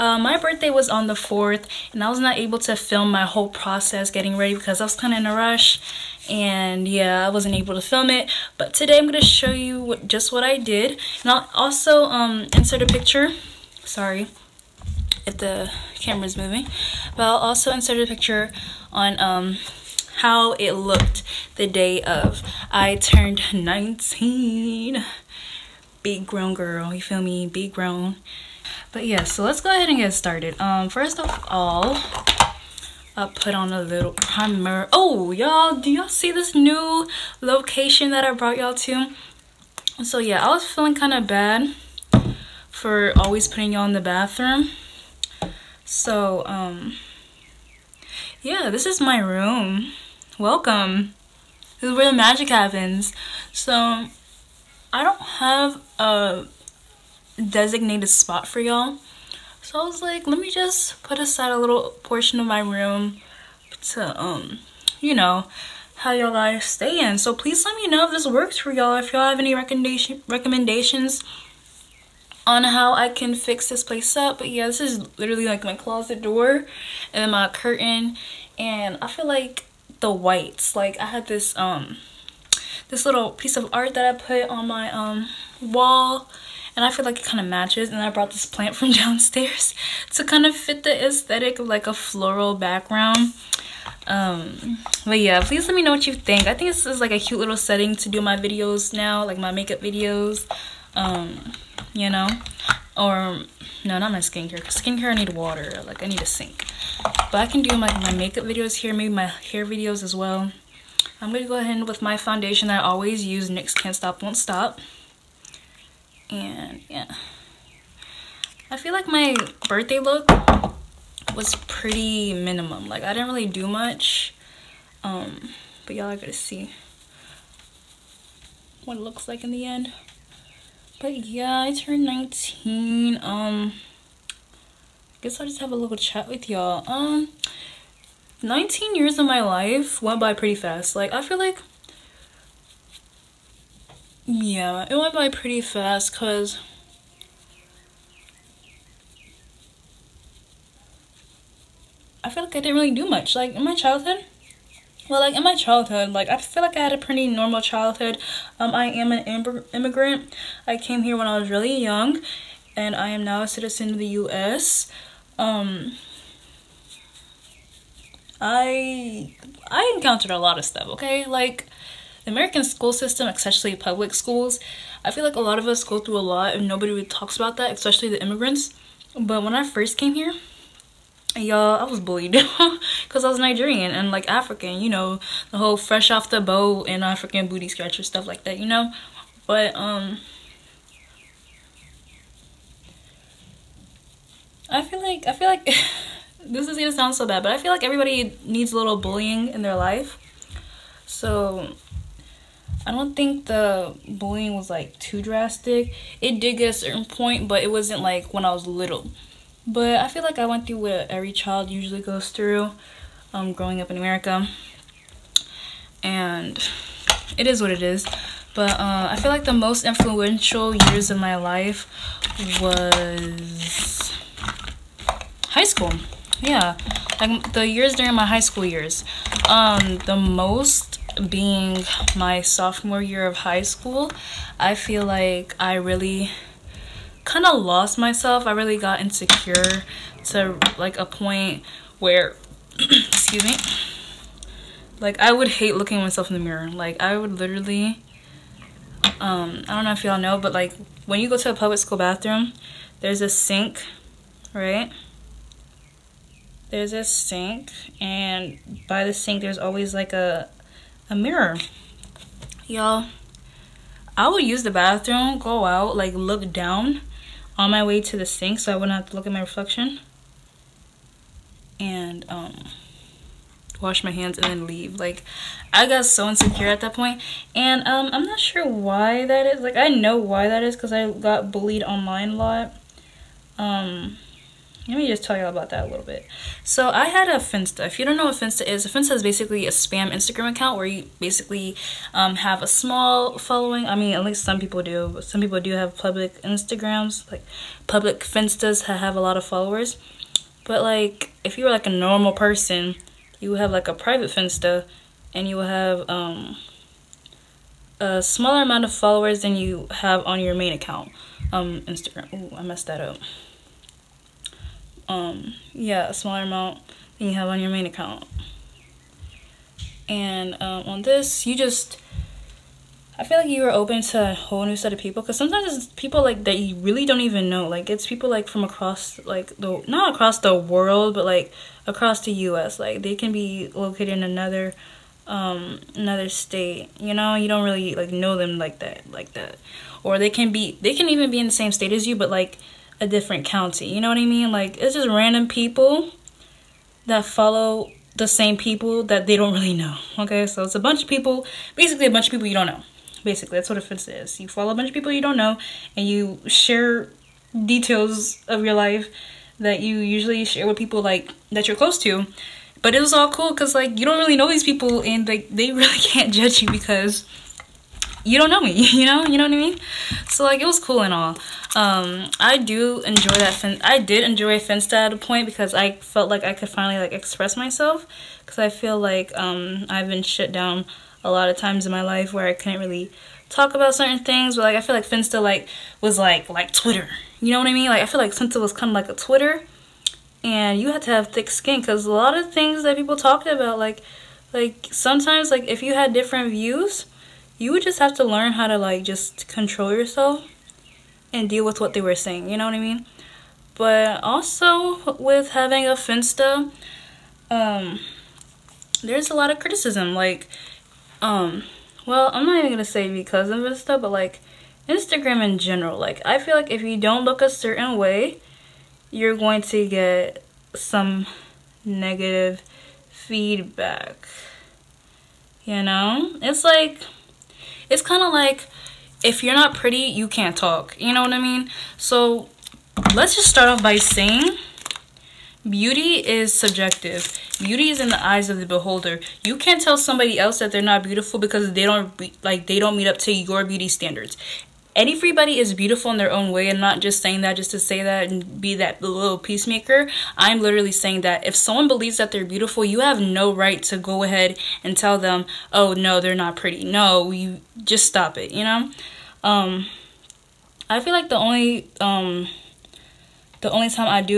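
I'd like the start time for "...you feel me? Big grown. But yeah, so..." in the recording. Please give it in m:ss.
0:26.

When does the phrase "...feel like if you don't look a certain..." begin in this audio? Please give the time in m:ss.
6:56.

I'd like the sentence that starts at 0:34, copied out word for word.
Oh, y'all, do y'all see this new location that I brought y'all to?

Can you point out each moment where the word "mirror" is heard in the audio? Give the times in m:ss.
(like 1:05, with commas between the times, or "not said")
4:06, 4:21.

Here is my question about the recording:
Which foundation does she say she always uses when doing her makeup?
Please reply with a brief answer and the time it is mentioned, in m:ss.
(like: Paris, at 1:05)
NYX Can't Stop Won't Stop, at 1:53.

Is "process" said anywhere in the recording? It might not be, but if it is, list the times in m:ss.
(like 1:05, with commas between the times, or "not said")
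0:03.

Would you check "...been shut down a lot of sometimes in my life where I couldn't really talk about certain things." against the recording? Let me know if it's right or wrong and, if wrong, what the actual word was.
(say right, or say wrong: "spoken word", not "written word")
wrong: "times", not "sometimes".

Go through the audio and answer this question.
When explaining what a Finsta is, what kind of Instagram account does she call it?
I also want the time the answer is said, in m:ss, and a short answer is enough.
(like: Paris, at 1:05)
spam, at 4:49.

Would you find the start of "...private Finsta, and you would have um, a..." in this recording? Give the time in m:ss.
5:03.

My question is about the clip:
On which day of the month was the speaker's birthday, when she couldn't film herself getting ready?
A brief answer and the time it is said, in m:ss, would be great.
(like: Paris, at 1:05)
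the 4th, at 0:01.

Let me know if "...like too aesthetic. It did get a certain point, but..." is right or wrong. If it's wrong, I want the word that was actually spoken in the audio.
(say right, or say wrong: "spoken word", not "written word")
wrong: "drastic", not "aesthetic".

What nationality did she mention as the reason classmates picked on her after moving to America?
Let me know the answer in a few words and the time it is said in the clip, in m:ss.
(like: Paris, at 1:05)
Nigerian, at 3:03.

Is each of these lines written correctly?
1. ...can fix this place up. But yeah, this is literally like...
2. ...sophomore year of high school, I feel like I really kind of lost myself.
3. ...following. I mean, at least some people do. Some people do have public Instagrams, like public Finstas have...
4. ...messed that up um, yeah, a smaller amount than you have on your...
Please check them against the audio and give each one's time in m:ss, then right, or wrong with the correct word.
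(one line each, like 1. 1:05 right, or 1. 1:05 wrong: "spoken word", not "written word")
1. 1:13 right
2. 3:52 right
3. 4:53 right
4. 5:12 right.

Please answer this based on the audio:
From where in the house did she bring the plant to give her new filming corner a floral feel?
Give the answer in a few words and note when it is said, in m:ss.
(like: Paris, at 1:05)
downstairs, at 1:28.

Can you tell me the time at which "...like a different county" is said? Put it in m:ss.
5:42.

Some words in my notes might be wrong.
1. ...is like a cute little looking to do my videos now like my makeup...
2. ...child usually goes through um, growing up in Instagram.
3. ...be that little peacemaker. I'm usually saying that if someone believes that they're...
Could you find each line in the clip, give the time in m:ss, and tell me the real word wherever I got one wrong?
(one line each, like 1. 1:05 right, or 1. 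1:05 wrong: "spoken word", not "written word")
1. 1:36 wrong: "setting", not "looking"
2. 3:31 wrong: "America", not "Instagram"
3. 7:28 wrong: "literally", not "usually".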